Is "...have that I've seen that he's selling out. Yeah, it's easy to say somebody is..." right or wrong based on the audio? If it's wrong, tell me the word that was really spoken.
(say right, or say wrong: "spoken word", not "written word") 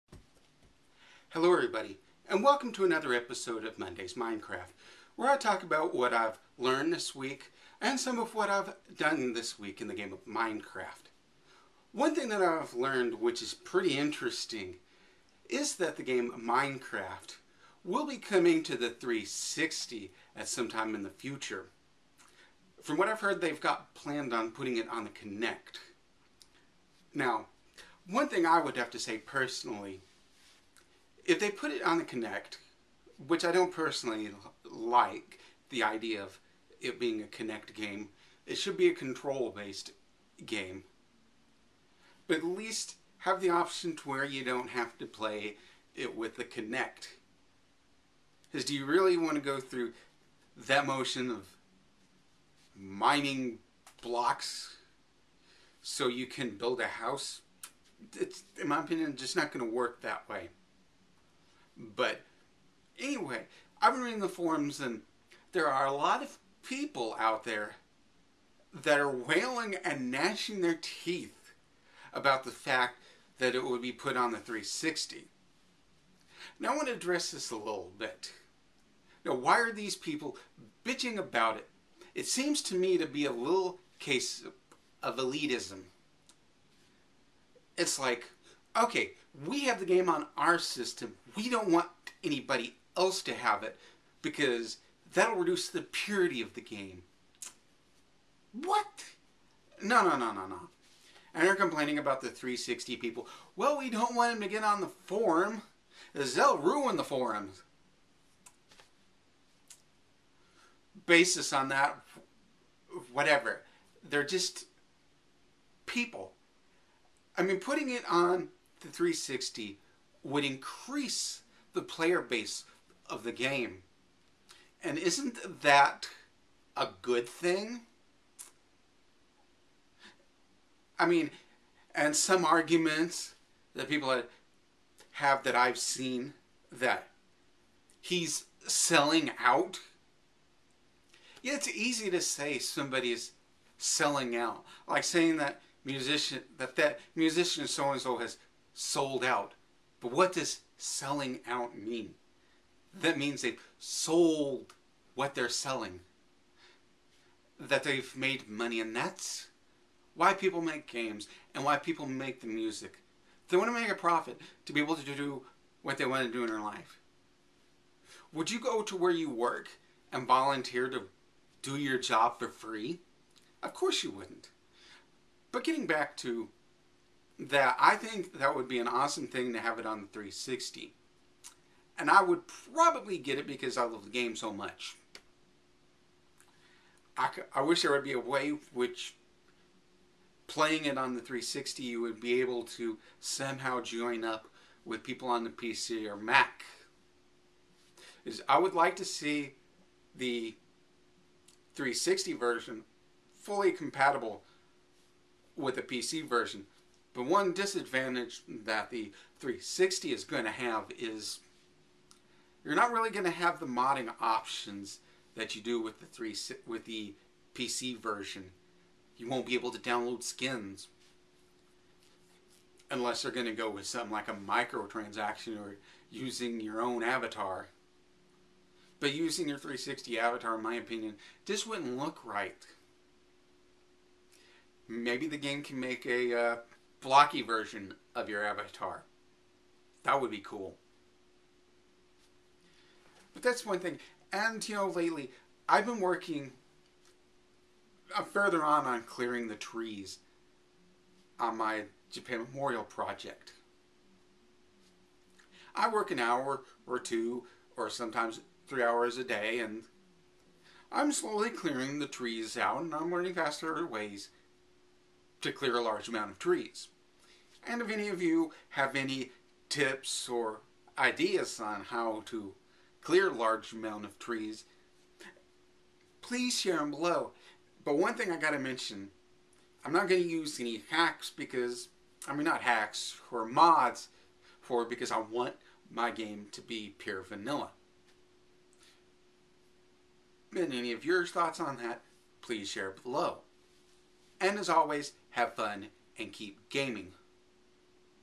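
right.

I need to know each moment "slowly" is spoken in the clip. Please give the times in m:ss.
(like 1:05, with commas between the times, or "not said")
4:21.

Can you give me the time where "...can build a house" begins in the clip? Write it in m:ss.
0:56.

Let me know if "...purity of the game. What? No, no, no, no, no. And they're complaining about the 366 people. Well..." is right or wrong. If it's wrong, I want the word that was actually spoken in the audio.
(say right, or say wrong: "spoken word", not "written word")
wrong: "360", not "366".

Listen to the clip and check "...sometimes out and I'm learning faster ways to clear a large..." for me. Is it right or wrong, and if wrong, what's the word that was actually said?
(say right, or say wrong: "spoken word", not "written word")
wrong: "trees", not "sometimes".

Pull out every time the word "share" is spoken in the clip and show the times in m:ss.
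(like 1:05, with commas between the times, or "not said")
4:36, 4:52.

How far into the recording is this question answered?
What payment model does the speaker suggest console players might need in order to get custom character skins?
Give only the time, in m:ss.
3:44.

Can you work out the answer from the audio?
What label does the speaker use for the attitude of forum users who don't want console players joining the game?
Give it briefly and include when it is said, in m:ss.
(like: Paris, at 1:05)
elitism, at 1:25.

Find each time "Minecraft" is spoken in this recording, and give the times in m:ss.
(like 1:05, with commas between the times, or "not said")
0:04, 0:10, 0:16.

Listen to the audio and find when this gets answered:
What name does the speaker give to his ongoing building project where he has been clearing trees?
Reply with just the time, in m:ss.
4:12.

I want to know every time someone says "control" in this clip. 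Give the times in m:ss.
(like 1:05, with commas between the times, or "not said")
0:38.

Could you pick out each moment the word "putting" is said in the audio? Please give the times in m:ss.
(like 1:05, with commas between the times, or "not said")
0:24, 1:57.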